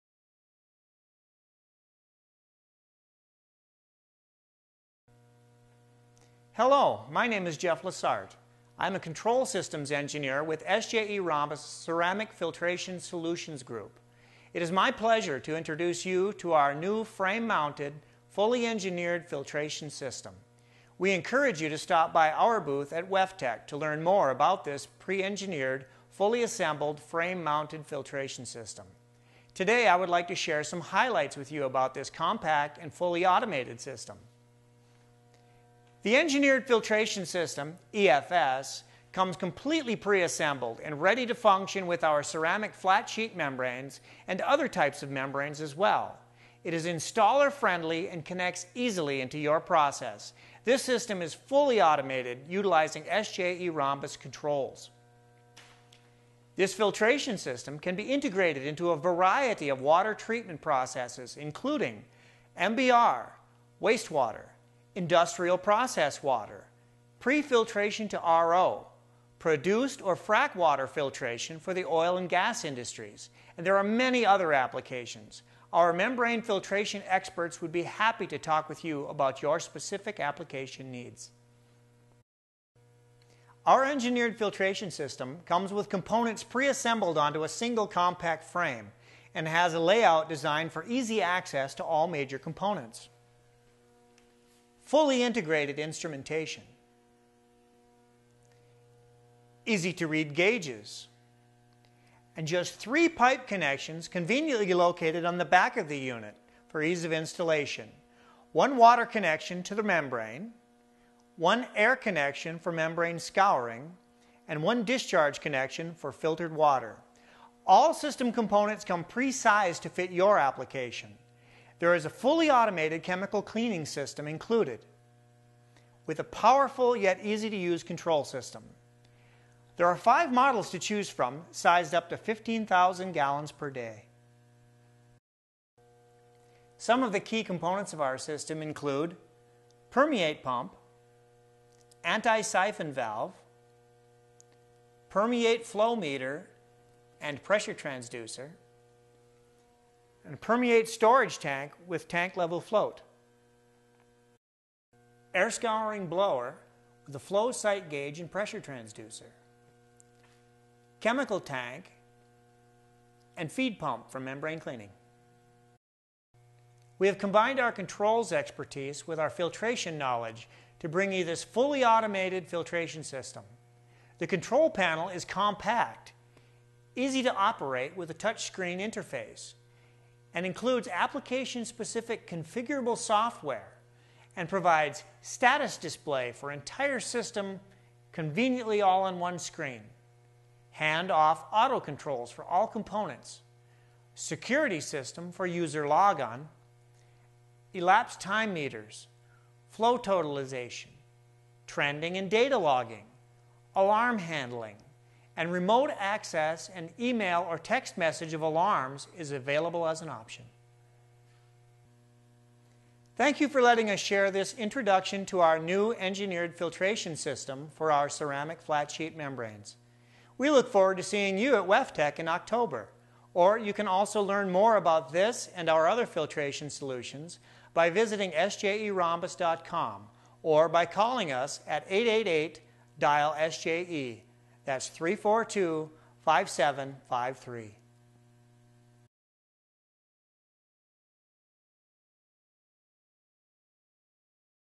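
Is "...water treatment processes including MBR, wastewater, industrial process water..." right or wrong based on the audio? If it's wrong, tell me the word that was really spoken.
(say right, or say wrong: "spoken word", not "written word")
right.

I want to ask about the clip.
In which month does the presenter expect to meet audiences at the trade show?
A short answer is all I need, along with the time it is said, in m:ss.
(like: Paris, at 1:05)
October, at 3:42.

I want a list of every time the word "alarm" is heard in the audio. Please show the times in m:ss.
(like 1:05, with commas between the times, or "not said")
3:23, 3:28.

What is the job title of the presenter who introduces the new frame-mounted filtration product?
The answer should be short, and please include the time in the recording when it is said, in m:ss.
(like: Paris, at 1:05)
Control systems engineer, at 0:08.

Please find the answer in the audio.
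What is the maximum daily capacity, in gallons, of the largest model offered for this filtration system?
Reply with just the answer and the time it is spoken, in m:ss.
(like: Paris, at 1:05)
15,000, at 2:12.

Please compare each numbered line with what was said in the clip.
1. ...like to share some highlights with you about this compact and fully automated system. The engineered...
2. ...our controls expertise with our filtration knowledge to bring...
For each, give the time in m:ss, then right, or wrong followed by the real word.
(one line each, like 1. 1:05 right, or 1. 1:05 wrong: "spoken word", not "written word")
1. 0:30 right
2. 2:47 right.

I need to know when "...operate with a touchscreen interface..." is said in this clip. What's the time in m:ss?
2:57.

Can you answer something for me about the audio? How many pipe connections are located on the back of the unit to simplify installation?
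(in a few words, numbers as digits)
3.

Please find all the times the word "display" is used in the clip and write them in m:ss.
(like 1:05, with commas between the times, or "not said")
3:05.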